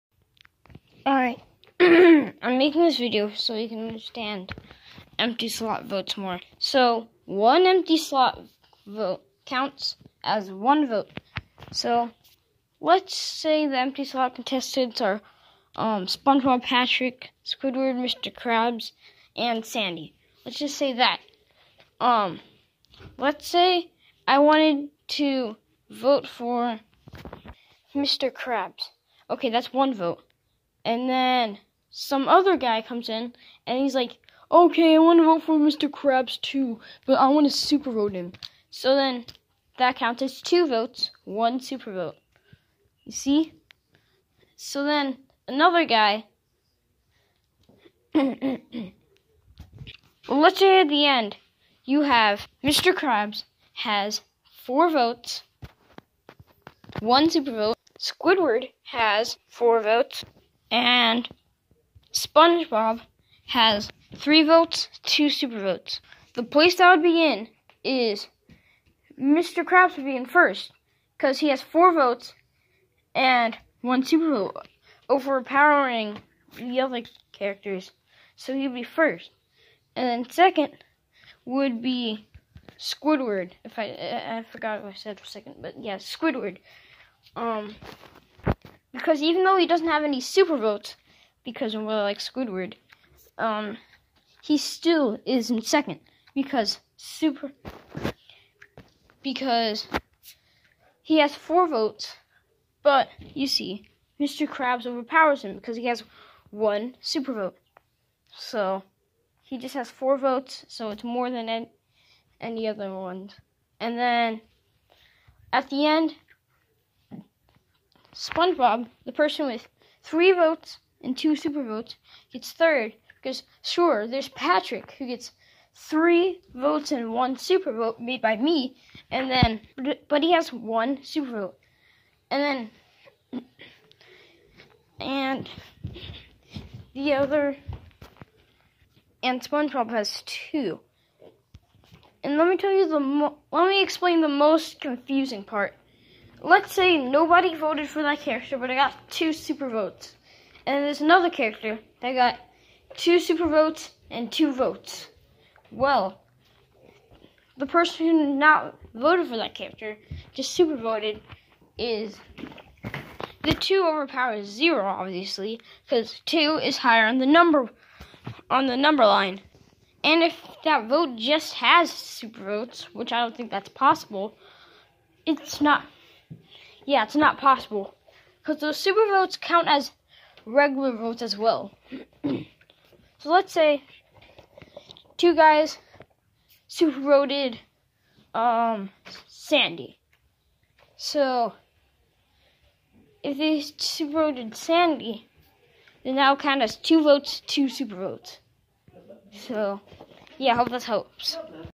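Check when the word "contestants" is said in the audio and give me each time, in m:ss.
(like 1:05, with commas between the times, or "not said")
0:14.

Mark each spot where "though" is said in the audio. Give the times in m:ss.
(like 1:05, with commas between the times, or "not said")
1:29.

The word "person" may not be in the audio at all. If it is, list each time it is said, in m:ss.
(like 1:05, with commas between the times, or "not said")
1:59, 2:37.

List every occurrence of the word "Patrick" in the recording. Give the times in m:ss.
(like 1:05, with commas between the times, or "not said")
0:16, 2:04.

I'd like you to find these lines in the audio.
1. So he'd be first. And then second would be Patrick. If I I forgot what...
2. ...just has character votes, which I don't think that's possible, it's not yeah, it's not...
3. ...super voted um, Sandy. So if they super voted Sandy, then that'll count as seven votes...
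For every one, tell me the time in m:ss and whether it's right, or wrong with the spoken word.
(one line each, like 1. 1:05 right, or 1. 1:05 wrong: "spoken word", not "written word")
1. 1:18 wrong: "Squidward", not "Patrick"
2. 2:51 wrong: "super", not "character"
3. 3:06 wrong: "two", not "seven".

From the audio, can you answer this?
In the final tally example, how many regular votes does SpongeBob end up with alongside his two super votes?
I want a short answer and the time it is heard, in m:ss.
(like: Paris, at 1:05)
3, at 1:02.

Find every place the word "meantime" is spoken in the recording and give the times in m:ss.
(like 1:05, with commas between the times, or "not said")
not said.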